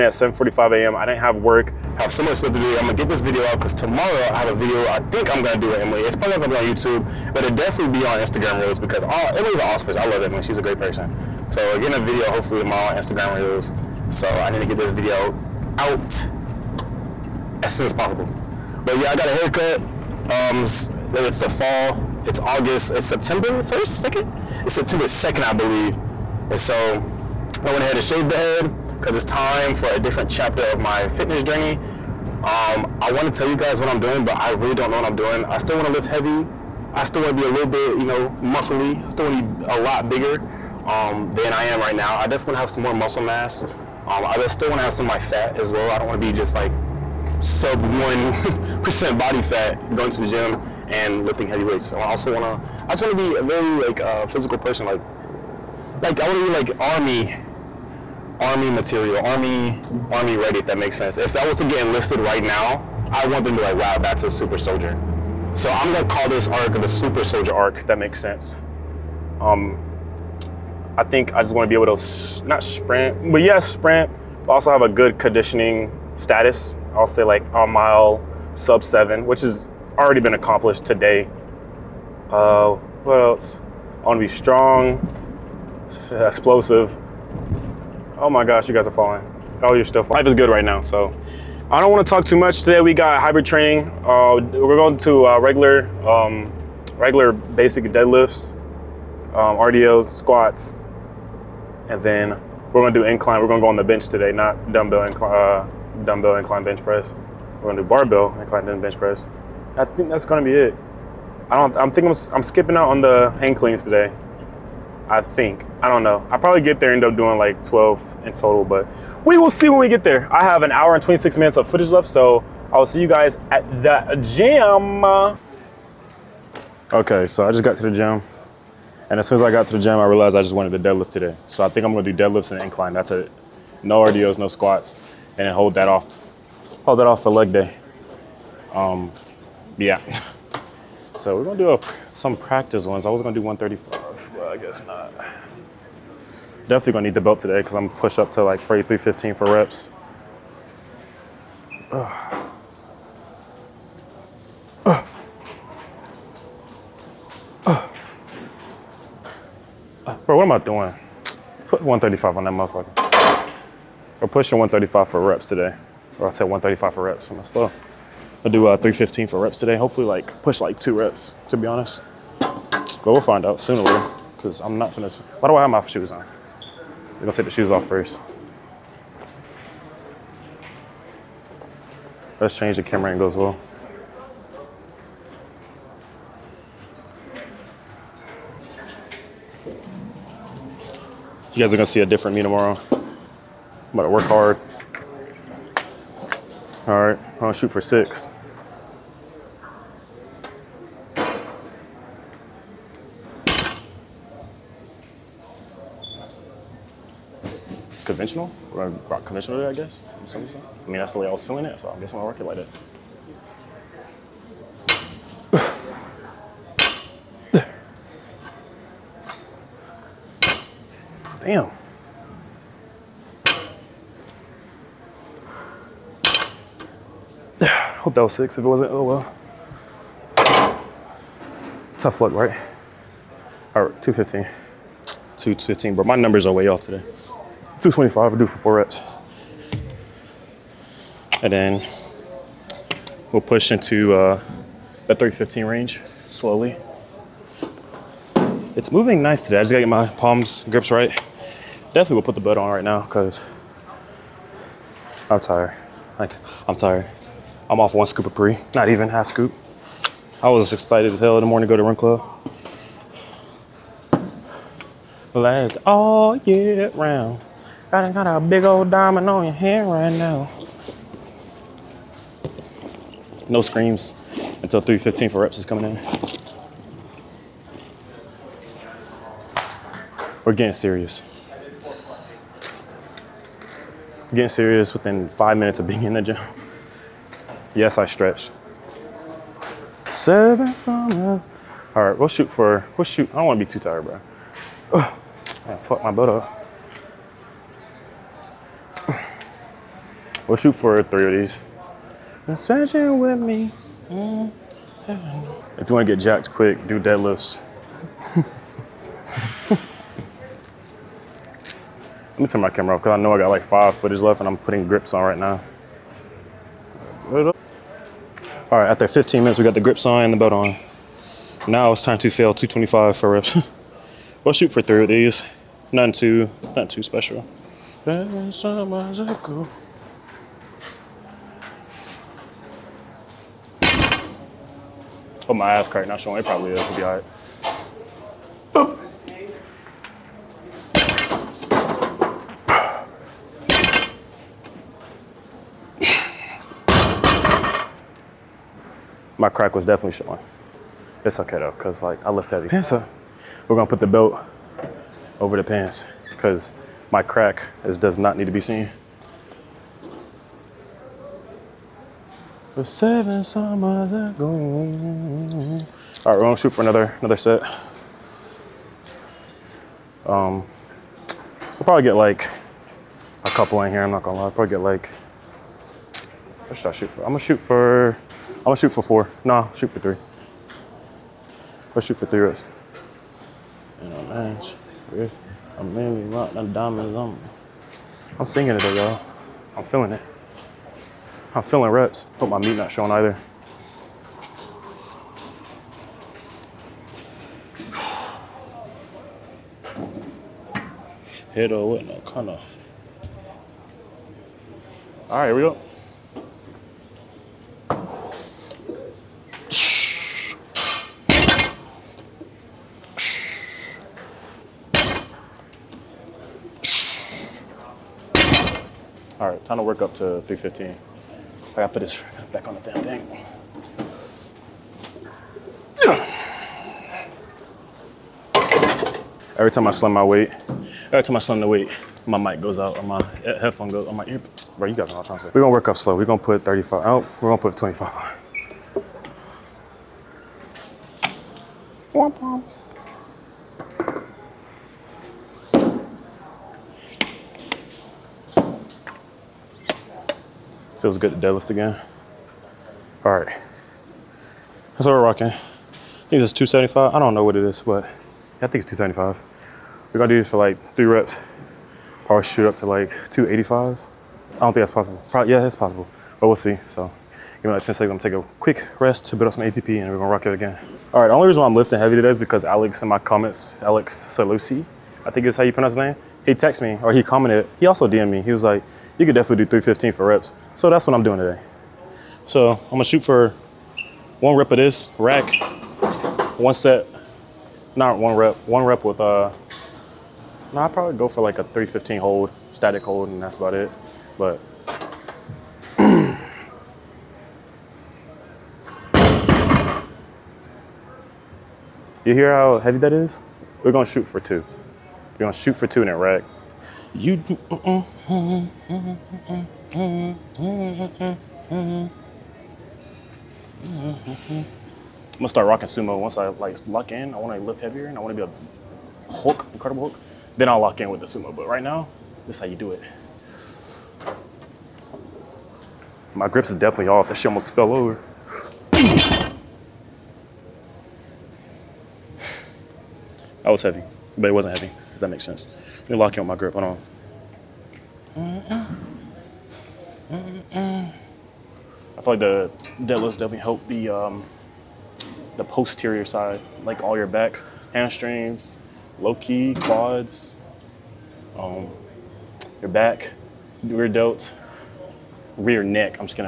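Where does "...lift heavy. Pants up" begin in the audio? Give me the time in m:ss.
5:52.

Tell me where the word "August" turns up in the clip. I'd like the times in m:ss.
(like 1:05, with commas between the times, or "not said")
0:22.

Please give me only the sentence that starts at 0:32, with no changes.
Um, I want to tell you guys what I'm doing, but I really don't know what I'm doing.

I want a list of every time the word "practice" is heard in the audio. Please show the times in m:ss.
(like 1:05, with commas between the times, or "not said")
2:22.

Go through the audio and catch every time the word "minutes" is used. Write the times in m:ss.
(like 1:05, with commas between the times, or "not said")
2:01, 4:45, 5:19.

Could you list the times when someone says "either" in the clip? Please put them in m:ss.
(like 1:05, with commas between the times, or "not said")
6:33.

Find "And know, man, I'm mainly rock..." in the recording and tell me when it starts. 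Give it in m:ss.
6:24.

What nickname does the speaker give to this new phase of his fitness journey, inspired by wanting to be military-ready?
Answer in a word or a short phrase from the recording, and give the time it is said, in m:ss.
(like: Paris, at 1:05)
super soldier arc, at 1:06.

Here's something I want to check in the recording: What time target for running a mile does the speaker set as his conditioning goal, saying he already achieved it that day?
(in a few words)
sub 7.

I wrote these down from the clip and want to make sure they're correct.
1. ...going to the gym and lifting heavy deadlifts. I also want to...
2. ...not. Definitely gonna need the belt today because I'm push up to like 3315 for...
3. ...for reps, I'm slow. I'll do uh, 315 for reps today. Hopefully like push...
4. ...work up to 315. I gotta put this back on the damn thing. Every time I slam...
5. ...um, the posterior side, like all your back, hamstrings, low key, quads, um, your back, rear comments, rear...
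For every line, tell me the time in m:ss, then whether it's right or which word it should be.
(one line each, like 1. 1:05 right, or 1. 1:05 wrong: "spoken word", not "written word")
1. 0:49 wrong: "weights", not "deadlifts"
2. 2:24 right
3. 2:46 right
4. 6:59 right
5. 9:04 wrong: "delts", not "comments".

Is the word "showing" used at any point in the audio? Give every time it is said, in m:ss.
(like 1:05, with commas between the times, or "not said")
5:36, 5:50, 6:32.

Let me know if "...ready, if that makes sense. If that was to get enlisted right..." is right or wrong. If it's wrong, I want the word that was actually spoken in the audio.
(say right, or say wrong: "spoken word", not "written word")
right.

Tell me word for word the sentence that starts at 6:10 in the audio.
Um, we'll probably get like a couple in here.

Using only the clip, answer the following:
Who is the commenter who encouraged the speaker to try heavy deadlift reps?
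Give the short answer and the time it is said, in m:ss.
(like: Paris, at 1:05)
Alex Salusi, at 7:53.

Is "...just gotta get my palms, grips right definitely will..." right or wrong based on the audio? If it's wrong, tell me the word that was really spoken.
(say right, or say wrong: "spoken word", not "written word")
right.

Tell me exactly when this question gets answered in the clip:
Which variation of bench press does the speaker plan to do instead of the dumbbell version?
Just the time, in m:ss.
1:47.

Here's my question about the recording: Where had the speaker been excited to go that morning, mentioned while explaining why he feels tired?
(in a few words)
run club.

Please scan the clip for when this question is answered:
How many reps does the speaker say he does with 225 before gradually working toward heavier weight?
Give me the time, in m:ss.
3:58.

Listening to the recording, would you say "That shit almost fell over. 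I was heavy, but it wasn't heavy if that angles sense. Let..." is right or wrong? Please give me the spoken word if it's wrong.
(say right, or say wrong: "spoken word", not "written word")
wrong: "makes", not "angles".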